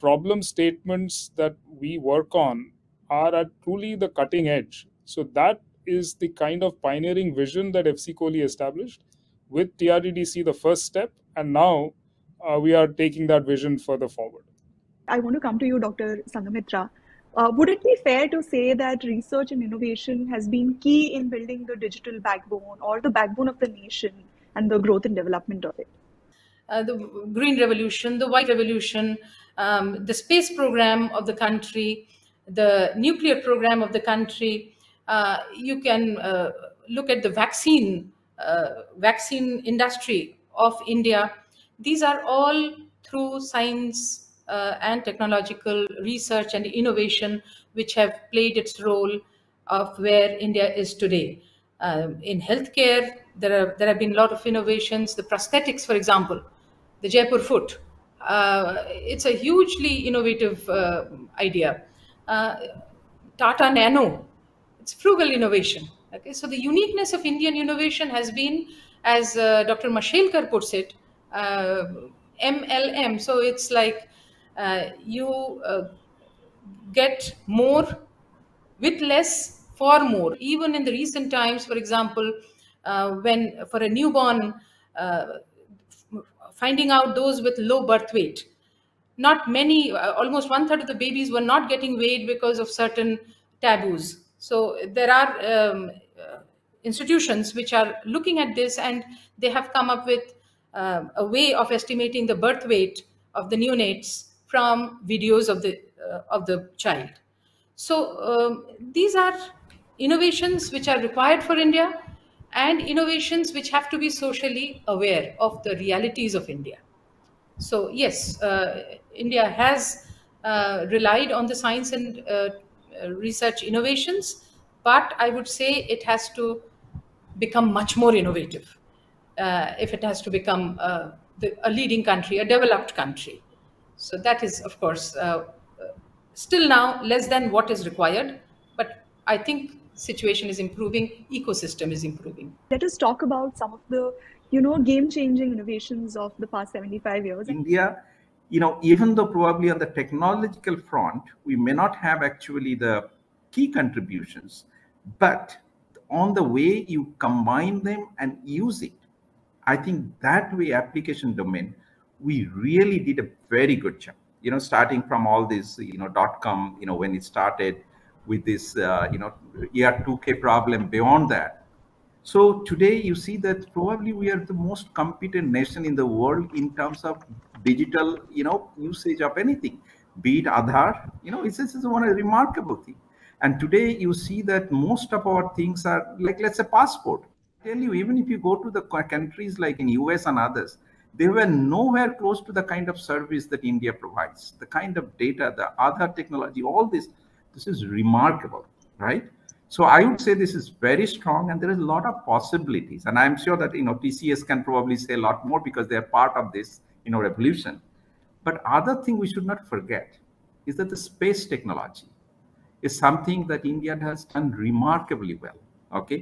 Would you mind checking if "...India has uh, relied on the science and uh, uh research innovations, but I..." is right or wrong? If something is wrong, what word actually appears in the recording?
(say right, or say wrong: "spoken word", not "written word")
right.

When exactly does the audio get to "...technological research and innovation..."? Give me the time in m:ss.
0:45.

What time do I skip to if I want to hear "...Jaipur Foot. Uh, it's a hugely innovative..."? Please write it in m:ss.
0:57.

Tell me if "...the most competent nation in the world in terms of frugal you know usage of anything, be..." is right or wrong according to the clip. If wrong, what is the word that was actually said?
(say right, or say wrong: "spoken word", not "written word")
wrong: "digital", not "frugal".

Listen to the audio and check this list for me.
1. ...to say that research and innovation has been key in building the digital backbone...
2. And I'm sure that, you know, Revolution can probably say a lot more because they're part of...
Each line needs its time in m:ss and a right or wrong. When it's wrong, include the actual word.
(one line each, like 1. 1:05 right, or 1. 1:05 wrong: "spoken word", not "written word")
1. 0:18 right
2. 3:23 wrong: "TCS", not "Revolution".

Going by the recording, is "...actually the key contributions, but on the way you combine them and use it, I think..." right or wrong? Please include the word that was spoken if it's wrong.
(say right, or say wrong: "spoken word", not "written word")
right.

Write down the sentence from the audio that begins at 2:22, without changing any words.
Let us talk about some of the, you know, game-changing innovations of the past 75 years.